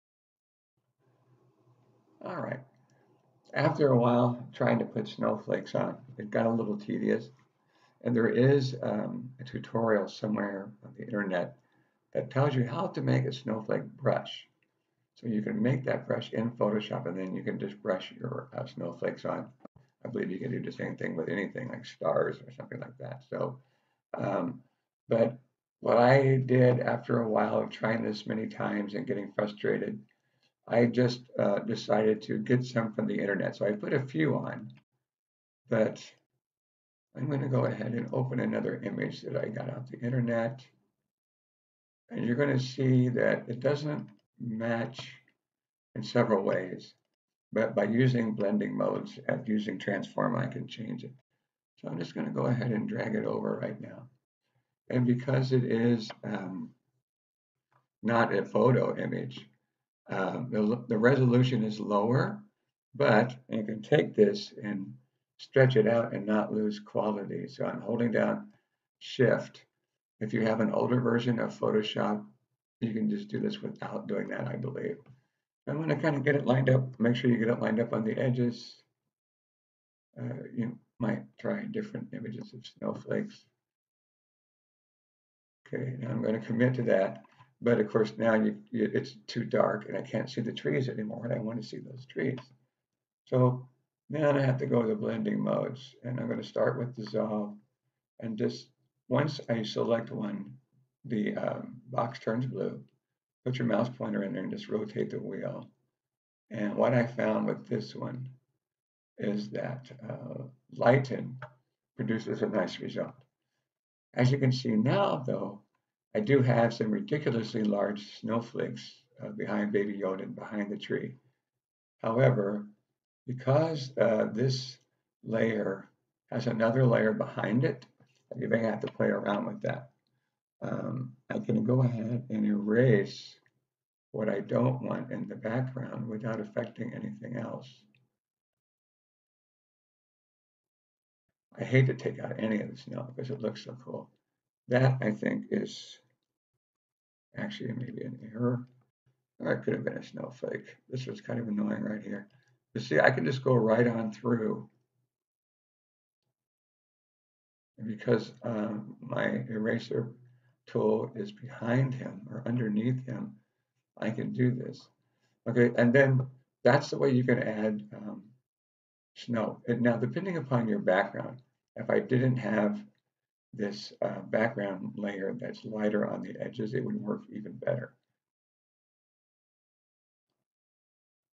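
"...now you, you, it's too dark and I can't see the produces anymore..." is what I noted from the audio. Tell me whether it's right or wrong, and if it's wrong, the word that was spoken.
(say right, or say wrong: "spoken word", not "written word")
wrong: "trees", not "produces".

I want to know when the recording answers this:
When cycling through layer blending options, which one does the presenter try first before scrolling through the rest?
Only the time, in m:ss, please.
1:36.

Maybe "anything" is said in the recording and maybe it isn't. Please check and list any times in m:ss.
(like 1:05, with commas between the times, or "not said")
0:21, 2:16.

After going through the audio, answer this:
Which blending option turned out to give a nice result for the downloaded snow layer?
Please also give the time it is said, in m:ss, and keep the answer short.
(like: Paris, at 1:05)
lighten, at 1:50.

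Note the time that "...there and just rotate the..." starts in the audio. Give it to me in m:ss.
1:44.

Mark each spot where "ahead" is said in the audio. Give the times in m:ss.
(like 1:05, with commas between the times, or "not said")
0:37, 0:52, 2:11.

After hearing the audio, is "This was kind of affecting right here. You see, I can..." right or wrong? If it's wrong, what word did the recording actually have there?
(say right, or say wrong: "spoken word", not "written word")
wrong: "annoying", not "affecting".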